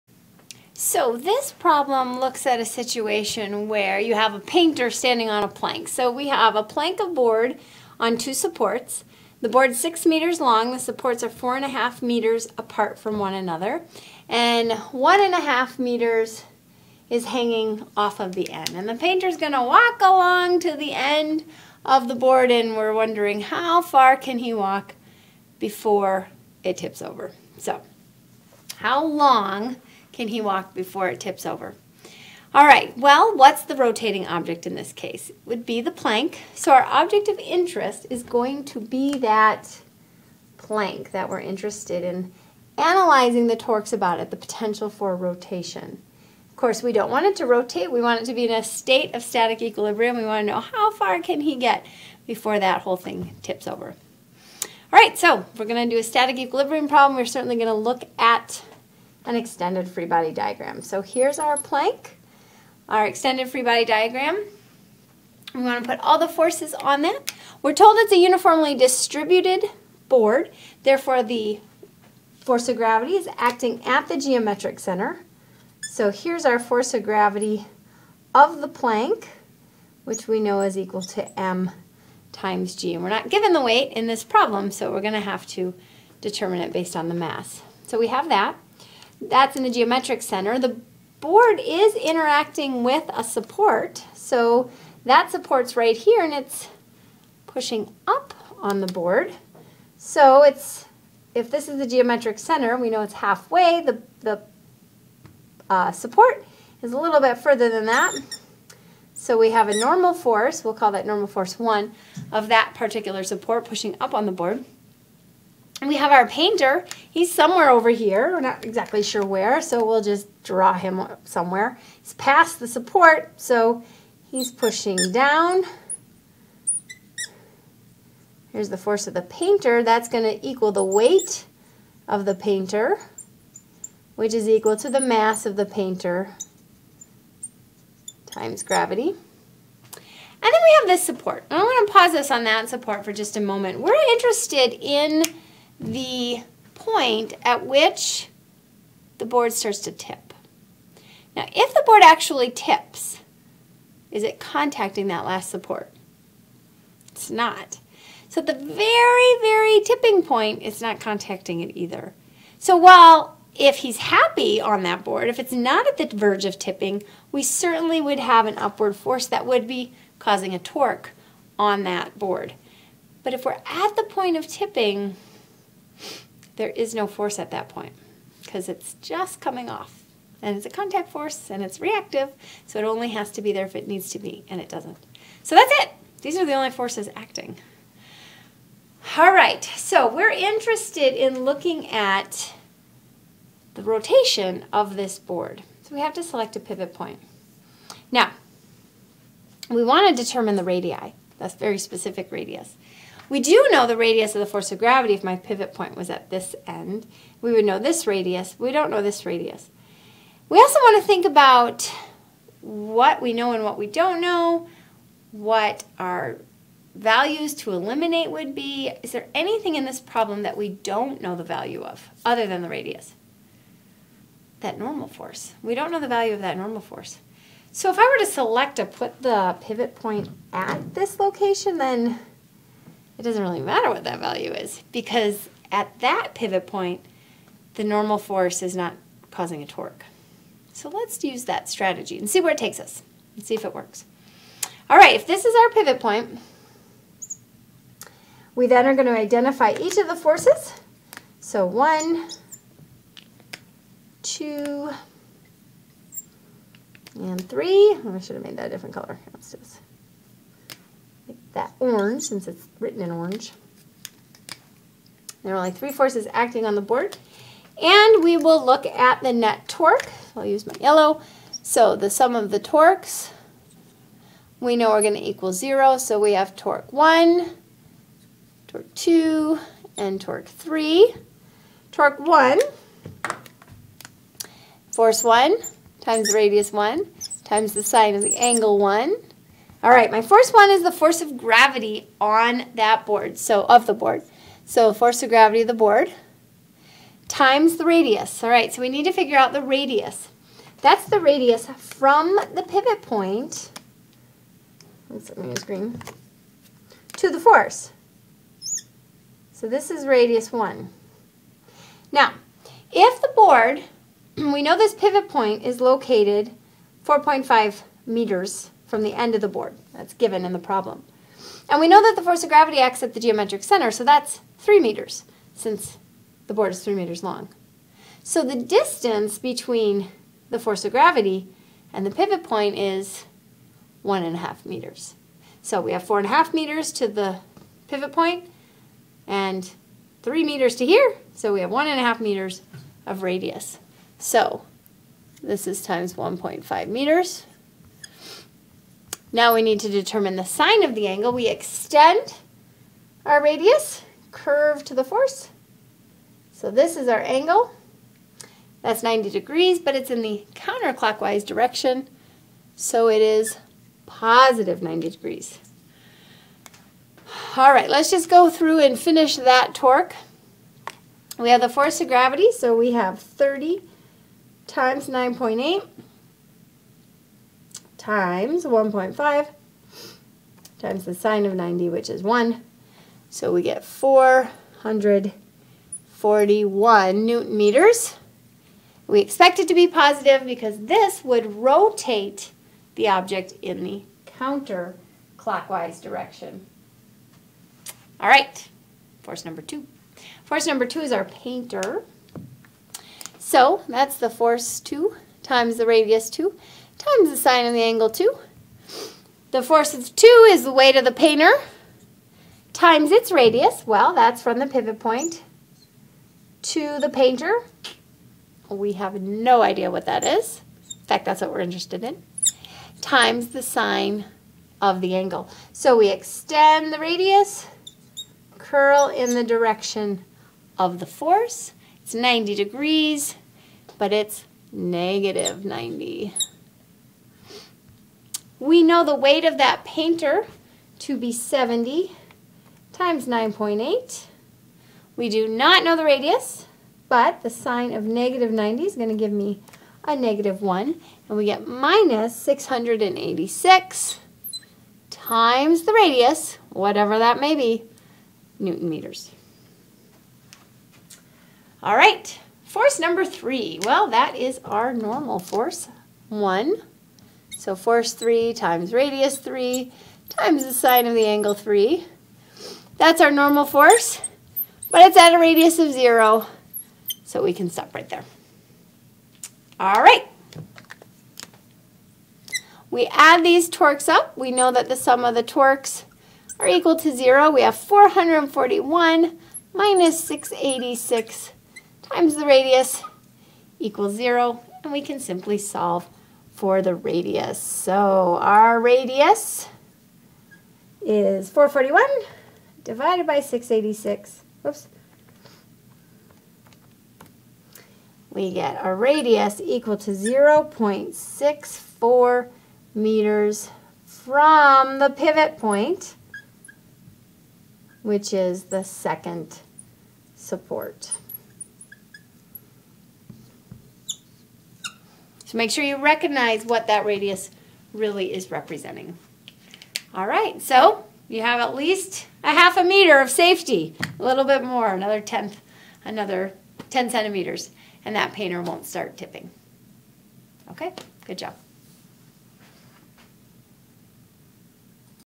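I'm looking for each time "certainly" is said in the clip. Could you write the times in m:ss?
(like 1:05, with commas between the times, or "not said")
0:57, 2:47.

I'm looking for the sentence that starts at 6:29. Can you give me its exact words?
We expect it to be positive because this would rotate the object in the counterclockwise direction.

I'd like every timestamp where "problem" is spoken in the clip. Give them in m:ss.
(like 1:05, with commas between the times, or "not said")
0:01, 0:56, 1:24, 3:40, 5:20.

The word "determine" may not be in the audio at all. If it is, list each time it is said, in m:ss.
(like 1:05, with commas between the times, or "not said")
1:26, 3:20, 5:49.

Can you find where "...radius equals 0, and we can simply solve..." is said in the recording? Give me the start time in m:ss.
8:12.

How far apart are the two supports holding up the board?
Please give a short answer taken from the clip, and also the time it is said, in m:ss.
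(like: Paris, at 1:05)
4.5 meters, at 0:11.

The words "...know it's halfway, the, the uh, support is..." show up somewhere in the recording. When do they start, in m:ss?
1:42.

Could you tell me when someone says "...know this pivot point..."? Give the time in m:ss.
5:14.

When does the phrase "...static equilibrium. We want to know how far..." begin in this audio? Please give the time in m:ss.
0:49.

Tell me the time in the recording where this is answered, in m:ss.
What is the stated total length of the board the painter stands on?
0:09.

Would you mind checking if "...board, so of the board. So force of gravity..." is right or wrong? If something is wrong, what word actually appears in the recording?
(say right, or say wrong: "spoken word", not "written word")
right.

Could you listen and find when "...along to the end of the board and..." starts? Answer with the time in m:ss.
0:20.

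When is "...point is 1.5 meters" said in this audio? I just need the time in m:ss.
5:32.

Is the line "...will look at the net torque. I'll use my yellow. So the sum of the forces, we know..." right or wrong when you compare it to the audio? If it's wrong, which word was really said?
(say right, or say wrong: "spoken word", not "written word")
wrong: "torques", not "forces".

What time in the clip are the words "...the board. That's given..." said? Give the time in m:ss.
5:19.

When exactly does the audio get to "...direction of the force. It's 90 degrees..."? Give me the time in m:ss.
7:09.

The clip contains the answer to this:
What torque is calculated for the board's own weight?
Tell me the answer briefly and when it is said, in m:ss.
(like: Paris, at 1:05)
441 newton meters, at 6:23.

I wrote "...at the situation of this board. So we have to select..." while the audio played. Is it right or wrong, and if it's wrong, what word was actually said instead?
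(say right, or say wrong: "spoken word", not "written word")
wrong: "rotation", not "situation".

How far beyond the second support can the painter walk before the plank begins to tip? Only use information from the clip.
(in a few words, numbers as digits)
0.64 meters.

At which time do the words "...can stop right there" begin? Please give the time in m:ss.
7:57.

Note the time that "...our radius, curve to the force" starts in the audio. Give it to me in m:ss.
5:53.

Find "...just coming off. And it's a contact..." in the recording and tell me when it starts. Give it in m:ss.
2:59.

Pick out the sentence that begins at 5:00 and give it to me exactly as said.
That's the radius from the pivot point, let's let me use green, to the force.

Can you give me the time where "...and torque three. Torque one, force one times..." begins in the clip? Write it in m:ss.
4:39.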